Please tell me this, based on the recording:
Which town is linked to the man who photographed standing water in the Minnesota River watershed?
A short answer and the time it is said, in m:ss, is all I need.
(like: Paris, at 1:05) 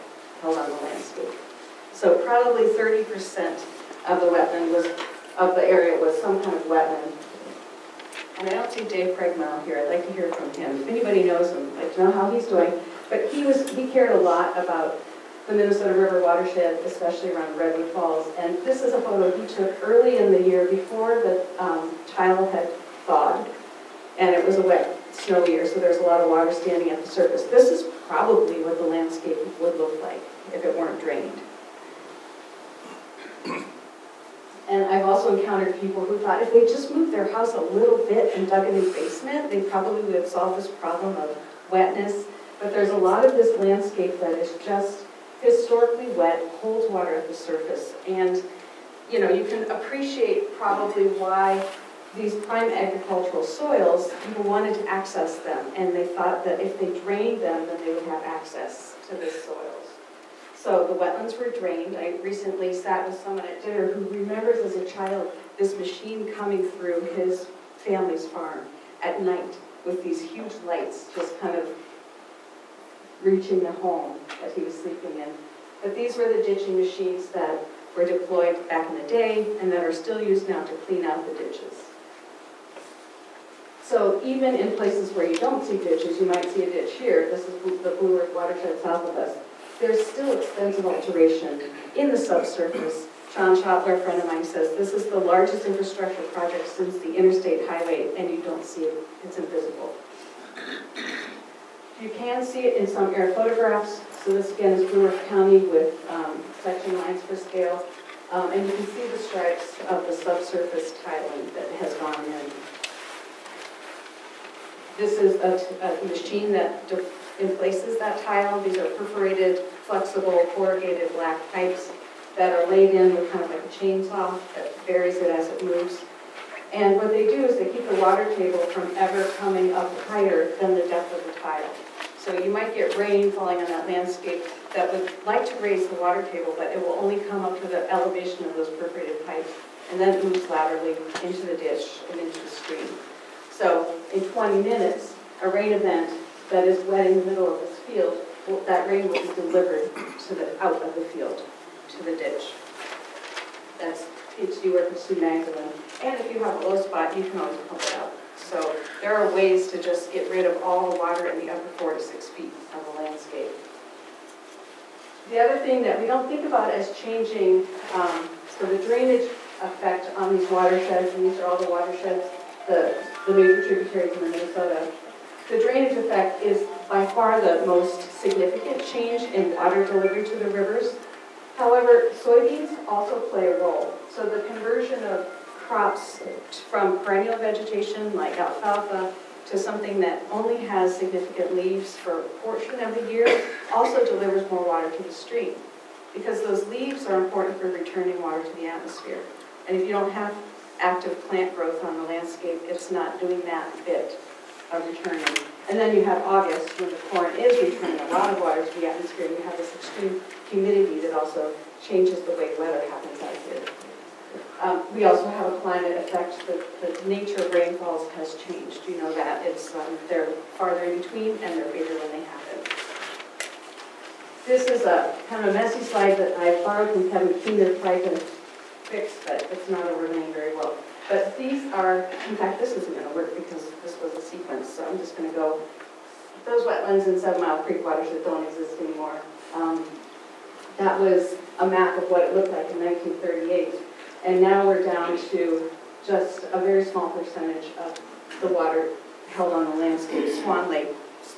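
Redwood Falls, at 0:17.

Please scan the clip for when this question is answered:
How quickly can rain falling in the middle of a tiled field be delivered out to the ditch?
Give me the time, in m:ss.
2:24.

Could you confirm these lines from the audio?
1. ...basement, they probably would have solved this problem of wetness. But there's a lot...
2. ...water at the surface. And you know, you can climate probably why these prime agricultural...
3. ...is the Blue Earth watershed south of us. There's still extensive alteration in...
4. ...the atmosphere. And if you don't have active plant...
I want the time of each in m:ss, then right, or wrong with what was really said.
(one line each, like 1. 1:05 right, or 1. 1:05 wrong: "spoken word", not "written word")
1. 0:38 right
2. 0:46 wrong: "appreciate", not "climate"
3. 1:27 right
4. 3:18 right.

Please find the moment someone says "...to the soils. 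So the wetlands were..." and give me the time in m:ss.
0:59.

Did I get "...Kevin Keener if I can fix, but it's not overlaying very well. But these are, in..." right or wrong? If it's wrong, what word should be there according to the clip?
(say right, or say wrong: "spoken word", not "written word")
right.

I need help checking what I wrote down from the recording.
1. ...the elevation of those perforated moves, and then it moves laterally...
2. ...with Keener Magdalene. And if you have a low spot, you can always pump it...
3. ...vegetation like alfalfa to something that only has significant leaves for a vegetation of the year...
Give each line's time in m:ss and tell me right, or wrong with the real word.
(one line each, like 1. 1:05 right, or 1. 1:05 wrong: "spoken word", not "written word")
1. 2:17 wrong: "pipes", not "moves"
2. 2:34 wrong: "Sue", not "Keener"
3. 3:07 wrong: "portion", not "vegetation".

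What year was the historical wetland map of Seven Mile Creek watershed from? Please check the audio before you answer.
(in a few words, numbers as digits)
1938.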